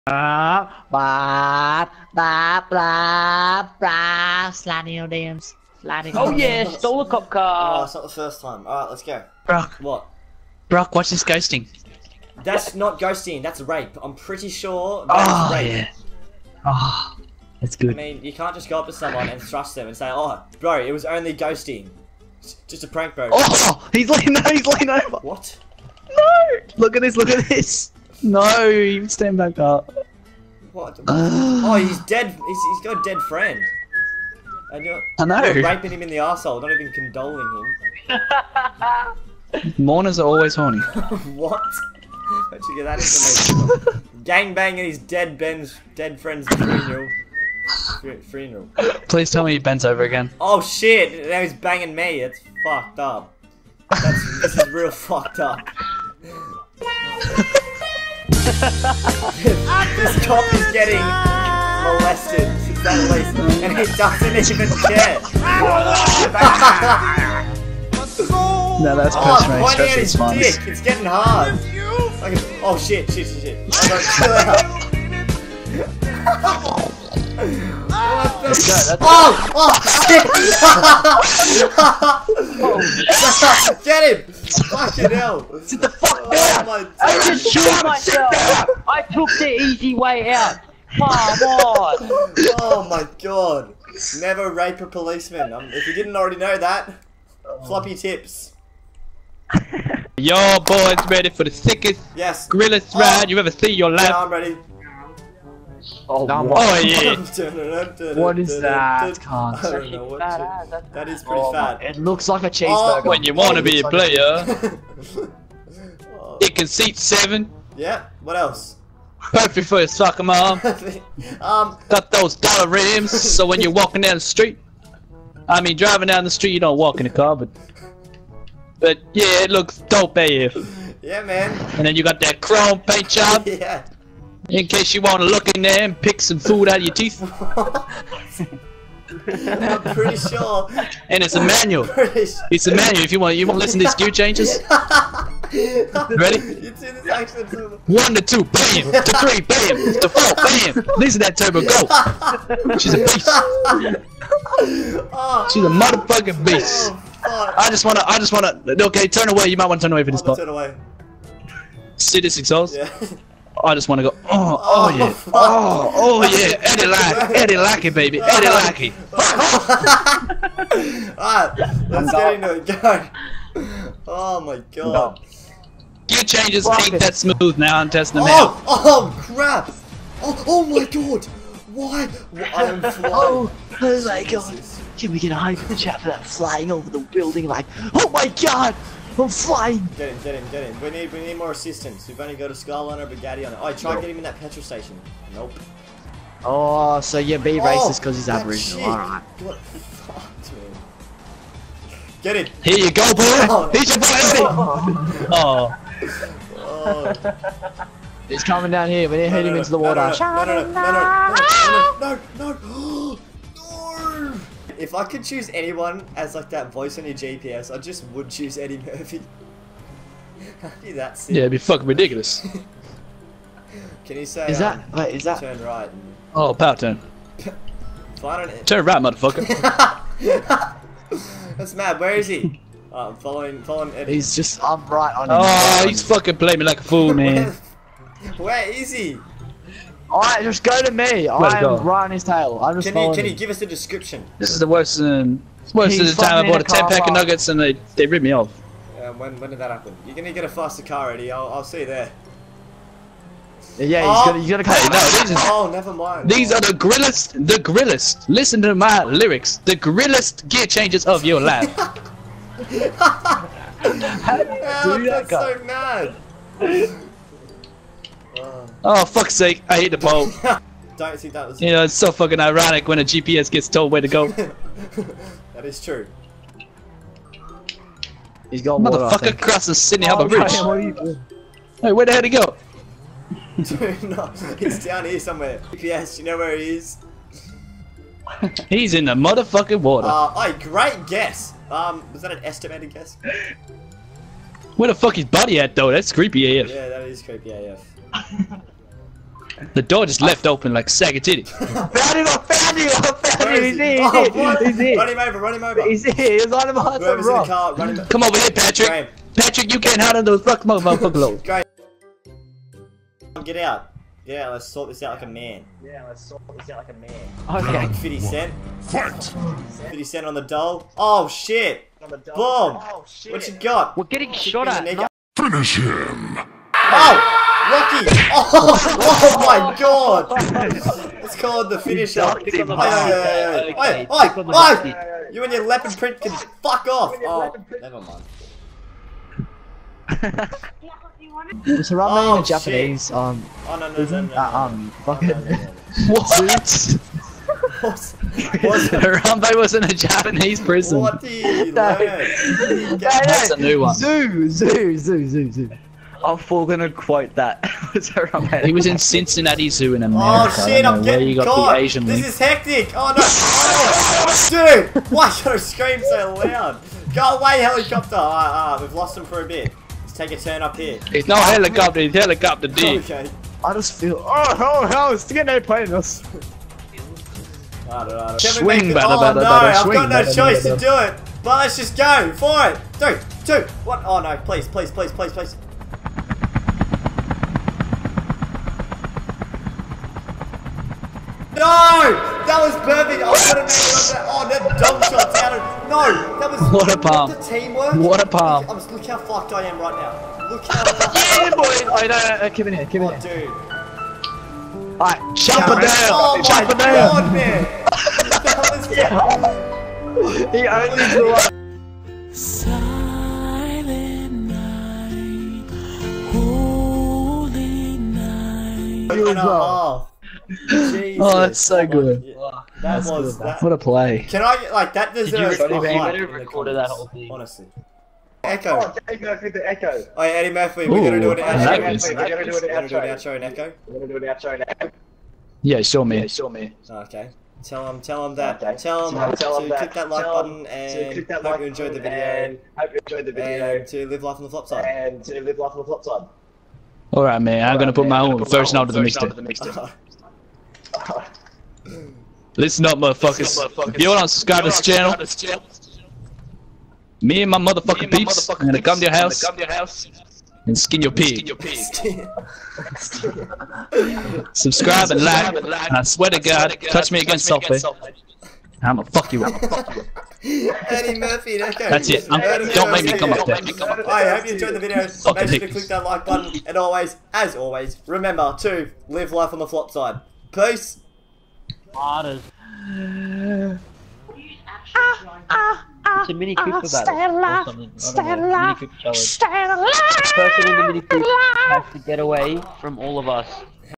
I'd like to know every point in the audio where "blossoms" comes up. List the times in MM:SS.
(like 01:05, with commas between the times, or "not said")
not said.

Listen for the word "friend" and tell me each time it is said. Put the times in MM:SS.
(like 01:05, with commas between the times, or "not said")
00:33, 00:46.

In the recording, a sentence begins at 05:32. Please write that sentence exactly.
Hey, hey, hey, You and your leopard print can fuck off!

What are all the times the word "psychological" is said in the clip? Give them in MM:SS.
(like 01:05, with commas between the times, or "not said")
not said.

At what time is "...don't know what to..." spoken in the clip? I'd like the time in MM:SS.
01:49.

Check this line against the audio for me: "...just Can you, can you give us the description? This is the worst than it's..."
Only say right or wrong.
right.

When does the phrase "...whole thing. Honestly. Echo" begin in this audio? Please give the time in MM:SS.
07:06.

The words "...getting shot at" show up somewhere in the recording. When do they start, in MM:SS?
05:24.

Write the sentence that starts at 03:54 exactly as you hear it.
He's just, I'm right on oh, him.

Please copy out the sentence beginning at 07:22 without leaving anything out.
And hope you enjoyed the video.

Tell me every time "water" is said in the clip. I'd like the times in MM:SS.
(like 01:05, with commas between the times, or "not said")
03:29, 04:38, 04:49.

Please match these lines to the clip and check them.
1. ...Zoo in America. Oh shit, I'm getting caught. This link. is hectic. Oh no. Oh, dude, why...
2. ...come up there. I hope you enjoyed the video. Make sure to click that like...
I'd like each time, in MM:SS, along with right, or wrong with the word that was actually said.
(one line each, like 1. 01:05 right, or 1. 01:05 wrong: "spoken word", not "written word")
1. 05:59 right
2. 07:53 right.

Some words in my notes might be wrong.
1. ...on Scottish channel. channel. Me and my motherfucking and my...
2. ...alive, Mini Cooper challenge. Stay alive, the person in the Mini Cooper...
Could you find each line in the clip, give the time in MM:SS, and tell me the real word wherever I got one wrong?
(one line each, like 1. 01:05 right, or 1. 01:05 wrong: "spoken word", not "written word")
1. 07:34 right
2. 08:08 right.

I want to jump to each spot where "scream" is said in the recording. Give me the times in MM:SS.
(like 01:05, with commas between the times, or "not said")
06:05.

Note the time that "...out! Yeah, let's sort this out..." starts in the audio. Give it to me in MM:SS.
05:13.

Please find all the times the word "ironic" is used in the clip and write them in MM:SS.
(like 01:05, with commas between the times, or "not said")
04:32.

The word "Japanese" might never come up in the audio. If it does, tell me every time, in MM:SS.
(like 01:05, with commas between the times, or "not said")
05:42, 05:49.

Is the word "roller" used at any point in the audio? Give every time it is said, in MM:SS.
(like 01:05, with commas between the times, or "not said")
not said.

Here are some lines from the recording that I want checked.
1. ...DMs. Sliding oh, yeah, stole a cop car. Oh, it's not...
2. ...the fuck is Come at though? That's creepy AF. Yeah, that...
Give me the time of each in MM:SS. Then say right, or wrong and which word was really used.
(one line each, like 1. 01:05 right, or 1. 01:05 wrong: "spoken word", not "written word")
1. 00:05 right
2. 04:54 wrong: "Buddy", not "Come".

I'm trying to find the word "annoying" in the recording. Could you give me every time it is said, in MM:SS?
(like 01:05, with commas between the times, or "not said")
not said.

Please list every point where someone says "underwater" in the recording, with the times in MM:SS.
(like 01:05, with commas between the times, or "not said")
not said.